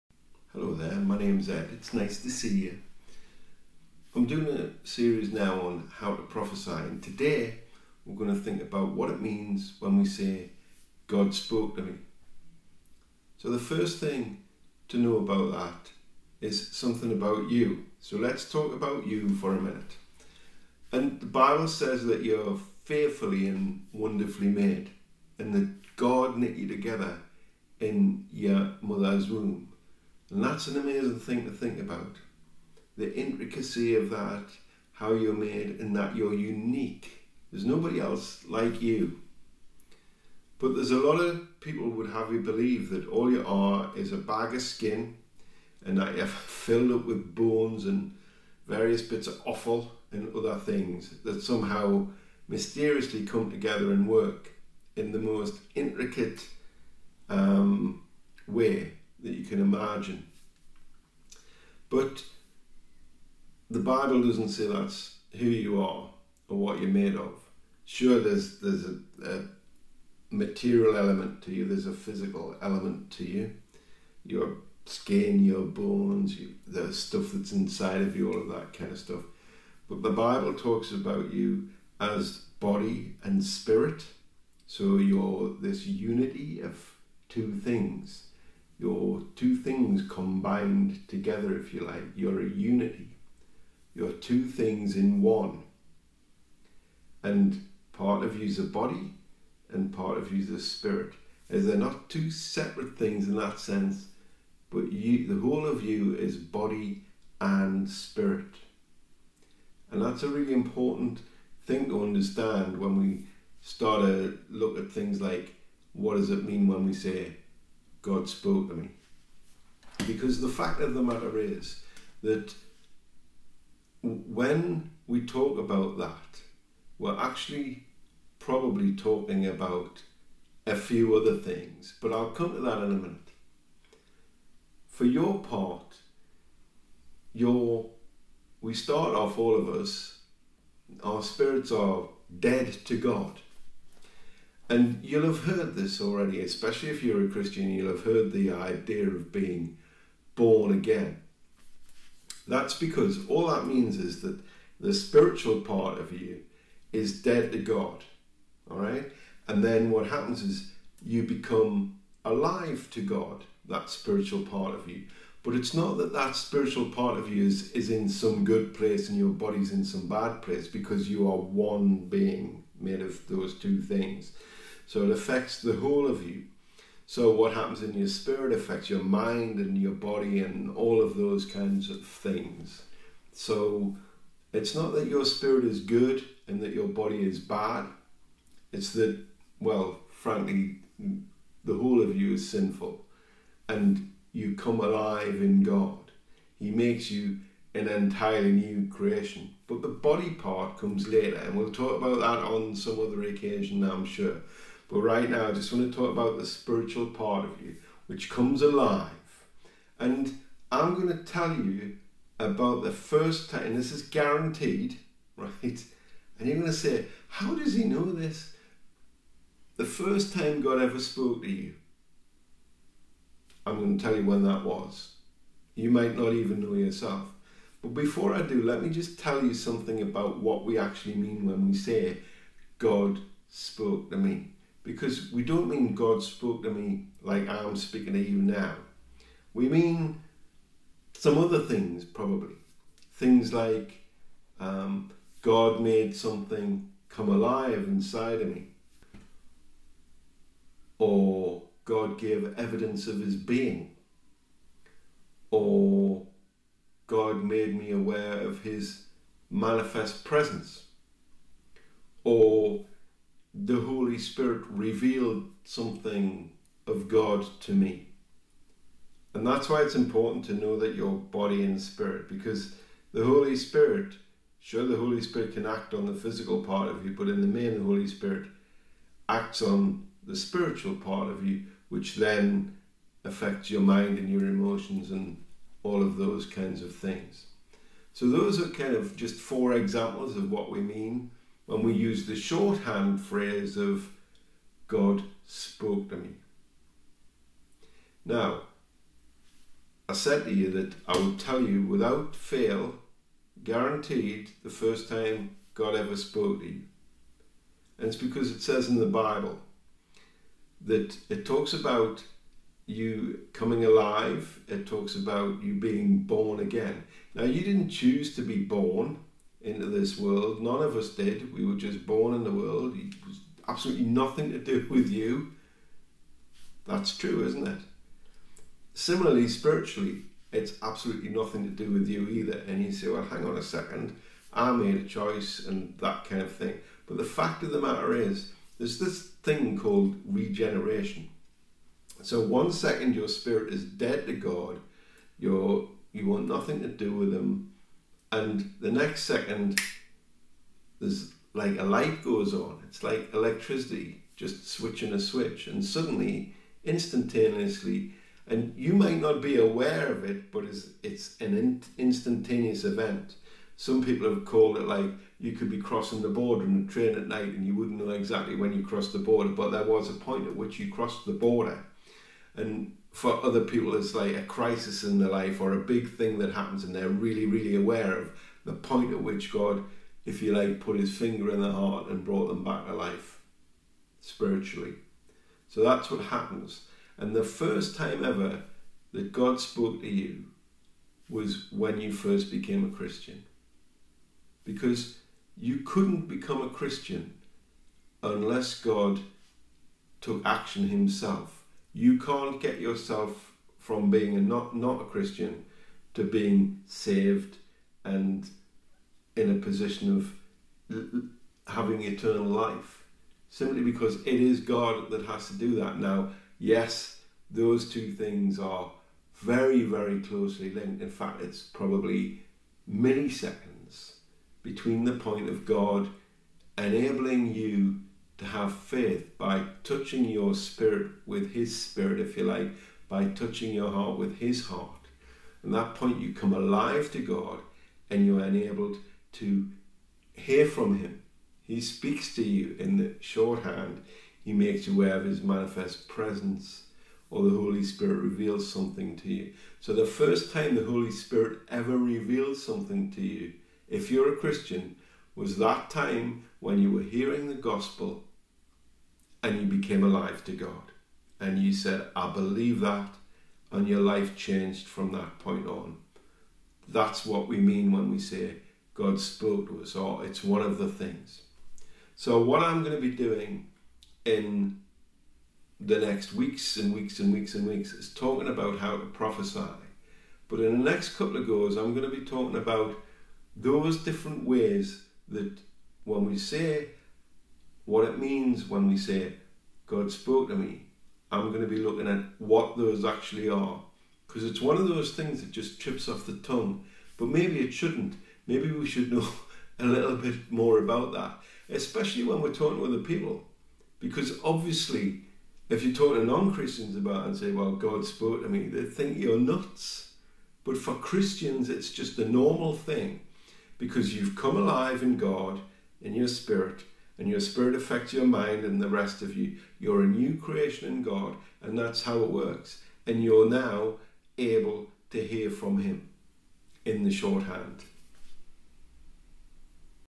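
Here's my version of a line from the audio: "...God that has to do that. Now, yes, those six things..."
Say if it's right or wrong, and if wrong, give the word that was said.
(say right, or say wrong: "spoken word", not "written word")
wrong: "two", not "six".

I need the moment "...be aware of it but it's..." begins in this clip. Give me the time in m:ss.
5:59.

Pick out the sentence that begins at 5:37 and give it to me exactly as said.
But the fact of the matter is, there's this thing called regeneration.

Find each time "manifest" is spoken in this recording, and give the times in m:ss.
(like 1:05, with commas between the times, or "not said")
4:19, 7:25.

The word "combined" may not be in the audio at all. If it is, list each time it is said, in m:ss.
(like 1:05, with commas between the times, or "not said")
1:30.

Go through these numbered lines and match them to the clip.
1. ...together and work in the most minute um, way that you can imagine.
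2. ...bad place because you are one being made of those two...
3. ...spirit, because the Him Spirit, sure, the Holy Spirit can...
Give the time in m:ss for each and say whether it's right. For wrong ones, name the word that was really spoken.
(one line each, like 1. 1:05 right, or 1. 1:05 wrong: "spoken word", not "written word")
1. 0:53 wrong: "intricate", not "minute"
2. 2:50 right
3. 4:31 wrong: "Holy", not "Him".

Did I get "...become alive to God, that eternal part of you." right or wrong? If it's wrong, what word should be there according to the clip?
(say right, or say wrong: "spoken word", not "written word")
wrong: "spiritual", not "eternal".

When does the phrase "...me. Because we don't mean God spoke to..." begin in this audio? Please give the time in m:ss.
3:54.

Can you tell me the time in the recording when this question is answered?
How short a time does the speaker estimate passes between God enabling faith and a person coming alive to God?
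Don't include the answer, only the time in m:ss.
7:02.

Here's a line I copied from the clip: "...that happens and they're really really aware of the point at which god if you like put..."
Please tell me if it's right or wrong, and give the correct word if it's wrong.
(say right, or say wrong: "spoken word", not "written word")
right.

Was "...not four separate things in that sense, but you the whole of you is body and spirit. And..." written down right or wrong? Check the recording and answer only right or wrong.
wrong.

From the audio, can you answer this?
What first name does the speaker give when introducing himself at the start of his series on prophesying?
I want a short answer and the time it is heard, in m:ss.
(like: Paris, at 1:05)
Ed, at 0:01.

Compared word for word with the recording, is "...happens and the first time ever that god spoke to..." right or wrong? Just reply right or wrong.
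right.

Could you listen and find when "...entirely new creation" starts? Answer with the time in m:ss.
3:17.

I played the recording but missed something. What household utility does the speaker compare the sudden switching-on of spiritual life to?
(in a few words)
electricity.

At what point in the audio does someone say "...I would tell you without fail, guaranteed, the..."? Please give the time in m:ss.
5:01.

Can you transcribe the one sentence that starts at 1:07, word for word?
Sure, there's there's a, a material element to you.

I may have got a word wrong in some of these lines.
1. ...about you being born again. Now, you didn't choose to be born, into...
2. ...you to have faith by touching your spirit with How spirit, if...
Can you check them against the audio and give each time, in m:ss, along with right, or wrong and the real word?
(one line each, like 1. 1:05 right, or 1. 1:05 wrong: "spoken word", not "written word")
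1. 5:15 right
2. 7:07 wrong: "His", not "How".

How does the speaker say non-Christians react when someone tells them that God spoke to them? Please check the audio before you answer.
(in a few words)
they think you're nuts.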